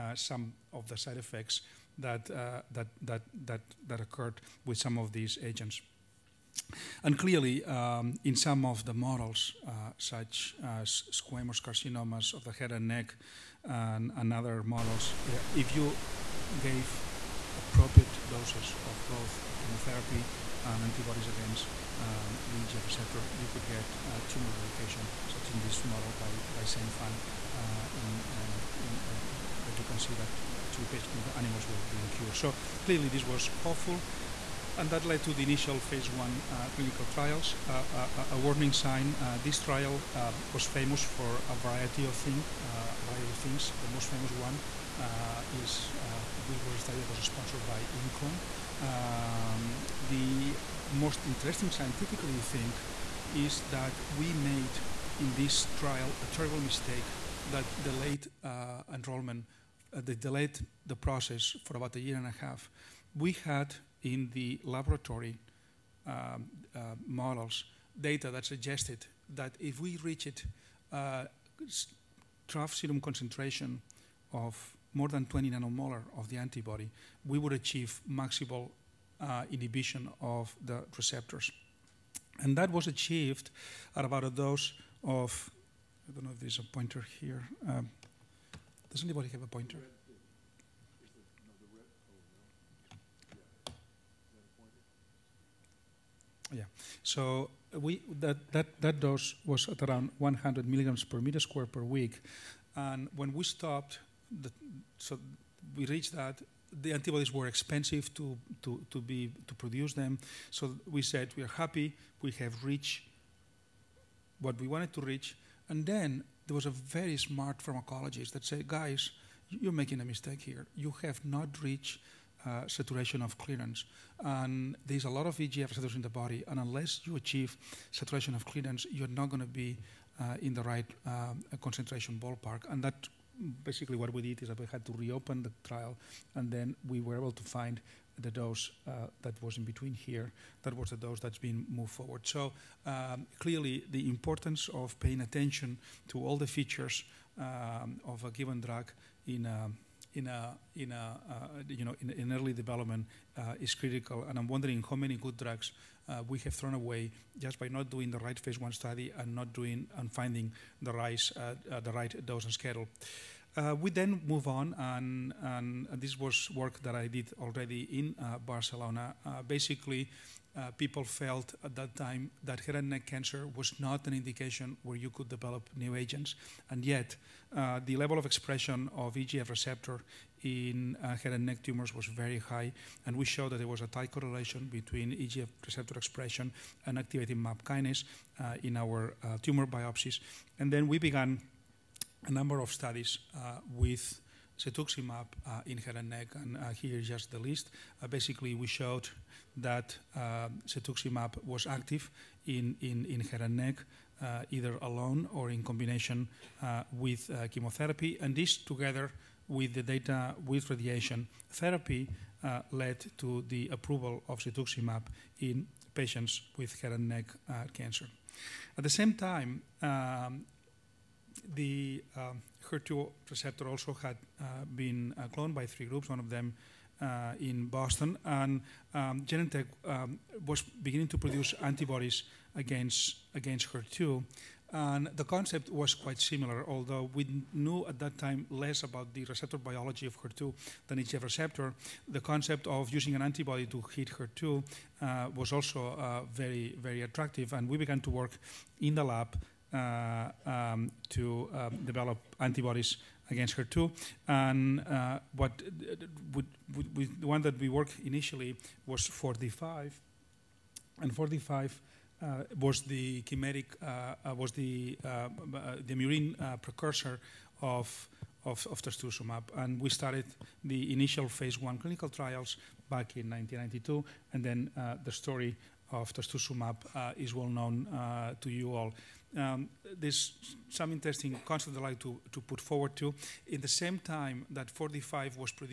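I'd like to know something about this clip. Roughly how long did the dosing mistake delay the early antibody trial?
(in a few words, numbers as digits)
About a year and a half.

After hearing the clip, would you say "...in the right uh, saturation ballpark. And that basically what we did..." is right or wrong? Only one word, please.
wrong.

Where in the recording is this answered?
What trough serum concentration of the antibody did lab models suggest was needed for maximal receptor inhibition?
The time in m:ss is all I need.
1:14.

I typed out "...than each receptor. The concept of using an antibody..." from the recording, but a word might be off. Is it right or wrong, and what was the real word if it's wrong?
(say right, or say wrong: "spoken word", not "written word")
right.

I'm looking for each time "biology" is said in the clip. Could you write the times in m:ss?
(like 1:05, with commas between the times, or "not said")
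3:59.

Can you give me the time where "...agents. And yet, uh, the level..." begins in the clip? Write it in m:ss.
2:55.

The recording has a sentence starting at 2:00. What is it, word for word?
You have not reached uh, saturation of clearance.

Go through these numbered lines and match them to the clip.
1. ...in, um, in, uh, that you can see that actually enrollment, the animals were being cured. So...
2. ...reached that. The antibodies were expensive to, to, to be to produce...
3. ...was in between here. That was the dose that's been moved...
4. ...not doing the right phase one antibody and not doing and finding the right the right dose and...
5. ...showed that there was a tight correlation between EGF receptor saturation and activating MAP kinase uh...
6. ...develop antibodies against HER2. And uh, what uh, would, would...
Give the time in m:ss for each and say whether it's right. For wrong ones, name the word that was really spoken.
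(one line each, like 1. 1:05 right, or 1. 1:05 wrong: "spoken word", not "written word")
1. 0:27 wrong: "patient", not "enrollment"
2. 1:45 right
3. 2:19 right
4. 2:37 wrong: "study", not "antibody"
5. 3:03 wrong: "expression", not "saturation"
6. 4:11 right.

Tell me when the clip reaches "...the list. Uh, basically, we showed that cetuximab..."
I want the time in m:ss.
3:17.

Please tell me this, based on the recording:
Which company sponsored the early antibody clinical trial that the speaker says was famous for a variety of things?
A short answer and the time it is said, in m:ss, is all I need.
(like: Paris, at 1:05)
ImClone, at 0:47.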